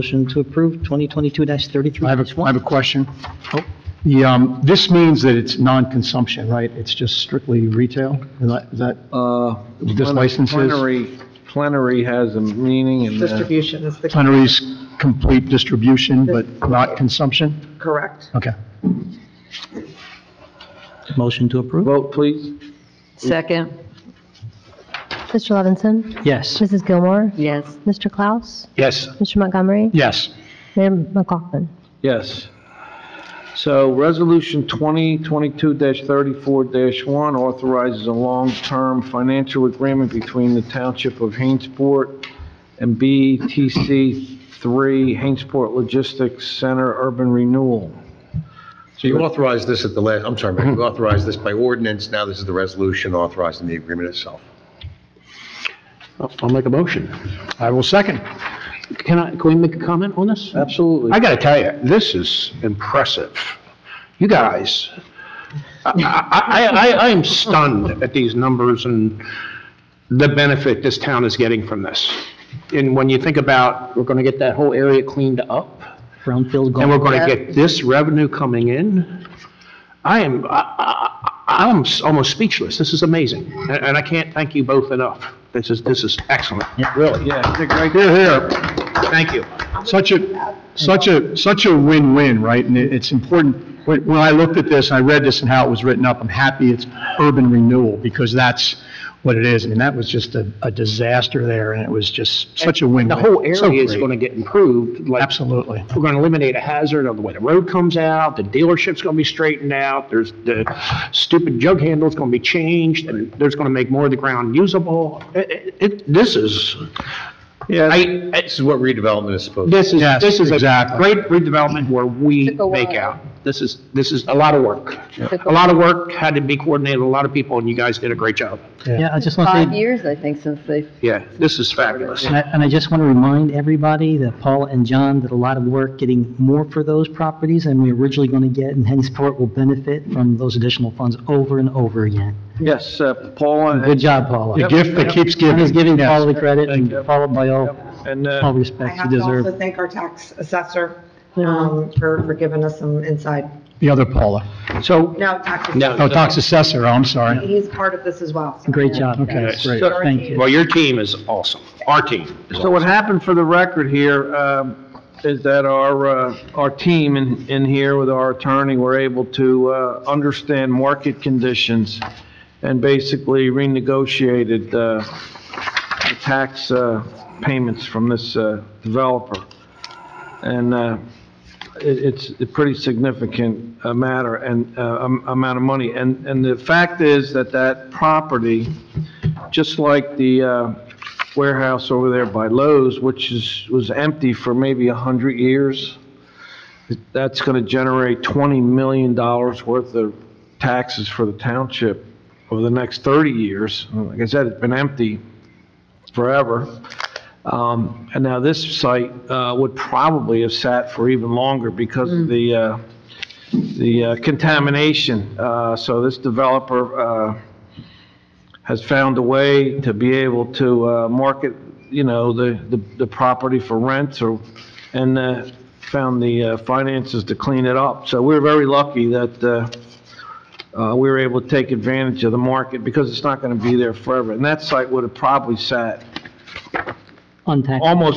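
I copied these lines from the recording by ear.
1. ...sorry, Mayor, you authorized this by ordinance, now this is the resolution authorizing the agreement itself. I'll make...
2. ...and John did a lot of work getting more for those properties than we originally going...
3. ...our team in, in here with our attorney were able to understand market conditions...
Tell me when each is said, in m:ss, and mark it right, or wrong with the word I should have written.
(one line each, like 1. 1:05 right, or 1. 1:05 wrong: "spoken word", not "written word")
1. 0:50 right
2. 2:14 right
3. 2:46 right.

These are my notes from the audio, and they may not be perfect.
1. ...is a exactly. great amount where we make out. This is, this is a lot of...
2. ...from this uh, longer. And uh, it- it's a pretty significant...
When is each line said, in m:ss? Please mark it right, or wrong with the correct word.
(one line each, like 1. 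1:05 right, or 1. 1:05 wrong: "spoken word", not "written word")
1. 2:00 wrong: "redevelopment", not "amount"
2. 2:57 wrong: "developer", not "longer".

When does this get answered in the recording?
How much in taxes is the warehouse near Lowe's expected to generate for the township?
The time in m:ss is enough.
3:18.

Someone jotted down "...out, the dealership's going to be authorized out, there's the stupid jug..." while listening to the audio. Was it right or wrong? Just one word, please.
wrong.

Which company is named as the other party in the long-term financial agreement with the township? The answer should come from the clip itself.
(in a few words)
BTC 3 Hainesport Logistics Center Urban Renewal.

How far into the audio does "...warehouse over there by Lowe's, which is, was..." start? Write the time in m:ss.
3:11.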